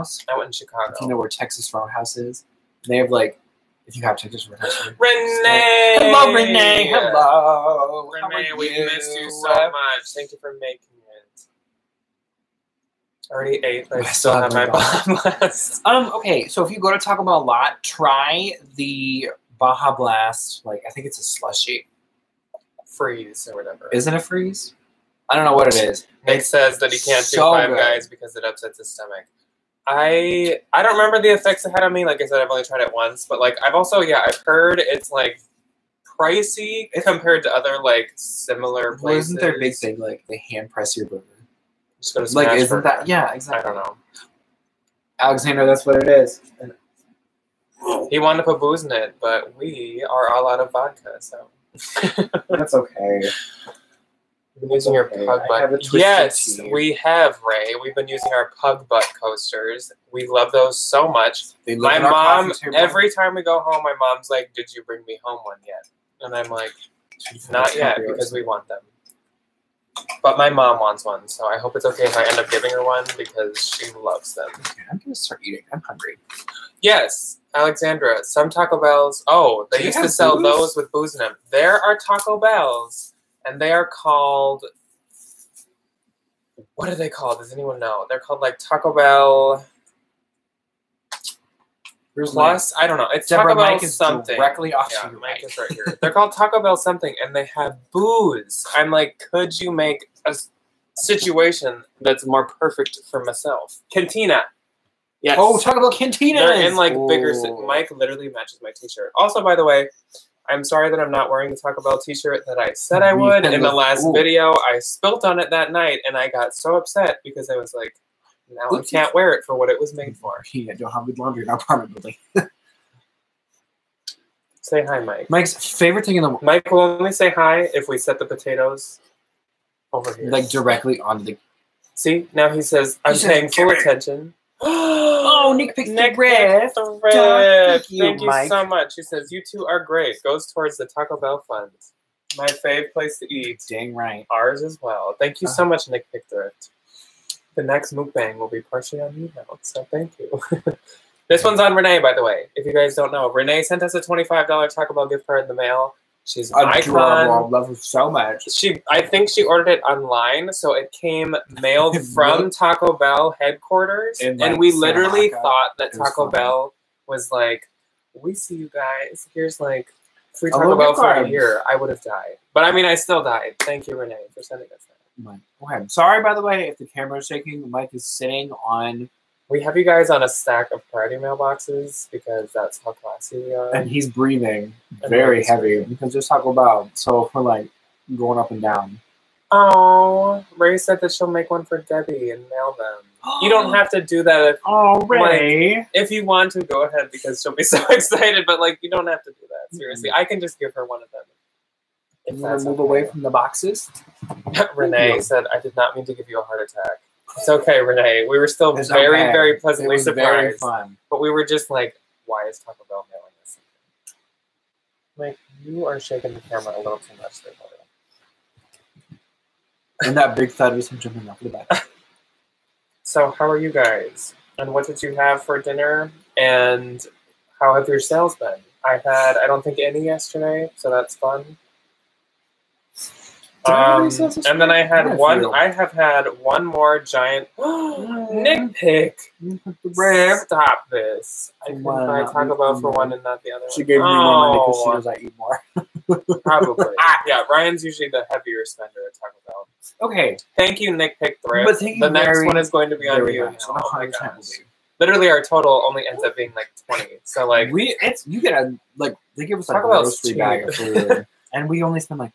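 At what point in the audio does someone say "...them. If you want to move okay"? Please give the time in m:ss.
3:21.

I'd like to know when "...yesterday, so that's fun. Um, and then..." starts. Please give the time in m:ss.
3:50.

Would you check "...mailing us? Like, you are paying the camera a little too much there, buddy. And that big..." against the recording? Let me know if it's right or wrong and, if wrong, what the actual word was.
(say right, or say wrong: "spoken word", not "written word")
wrong: "shaking", not "paying".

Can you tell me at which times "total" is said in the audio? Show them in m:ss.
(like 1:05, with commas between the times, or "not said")
4:15.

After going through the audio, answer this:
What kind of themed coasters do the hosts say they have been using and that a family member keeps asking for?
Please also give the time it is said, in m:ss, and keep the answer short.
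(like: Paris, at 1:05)
Pug butt coasters, at 0:58.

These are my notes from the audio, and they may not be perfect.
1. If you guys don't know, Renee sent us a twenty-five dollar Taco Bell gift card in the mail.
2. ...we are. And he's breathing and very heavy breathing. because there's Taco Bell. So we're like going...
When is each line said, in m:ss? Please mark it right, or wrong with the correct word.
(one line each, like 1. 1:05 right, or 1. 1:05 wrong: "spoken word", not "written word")
1. 2:32 right
2. 3:03 right.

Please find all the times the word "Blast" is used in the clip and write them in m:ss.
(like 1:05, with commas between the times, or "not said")
0:15, 0:19.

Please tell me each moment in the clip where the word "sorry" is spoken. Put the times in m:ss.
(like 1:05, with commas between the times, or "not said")
1:50, 2:55.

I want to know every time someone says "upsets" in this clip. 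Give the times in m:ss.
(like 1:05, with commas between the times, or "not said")
0:28, 1:56.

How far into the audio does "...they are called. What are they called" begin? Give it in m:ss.
1:23.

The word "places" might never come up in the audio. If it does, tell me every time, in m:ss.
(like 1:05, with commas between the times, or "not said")
0:38, 2:22.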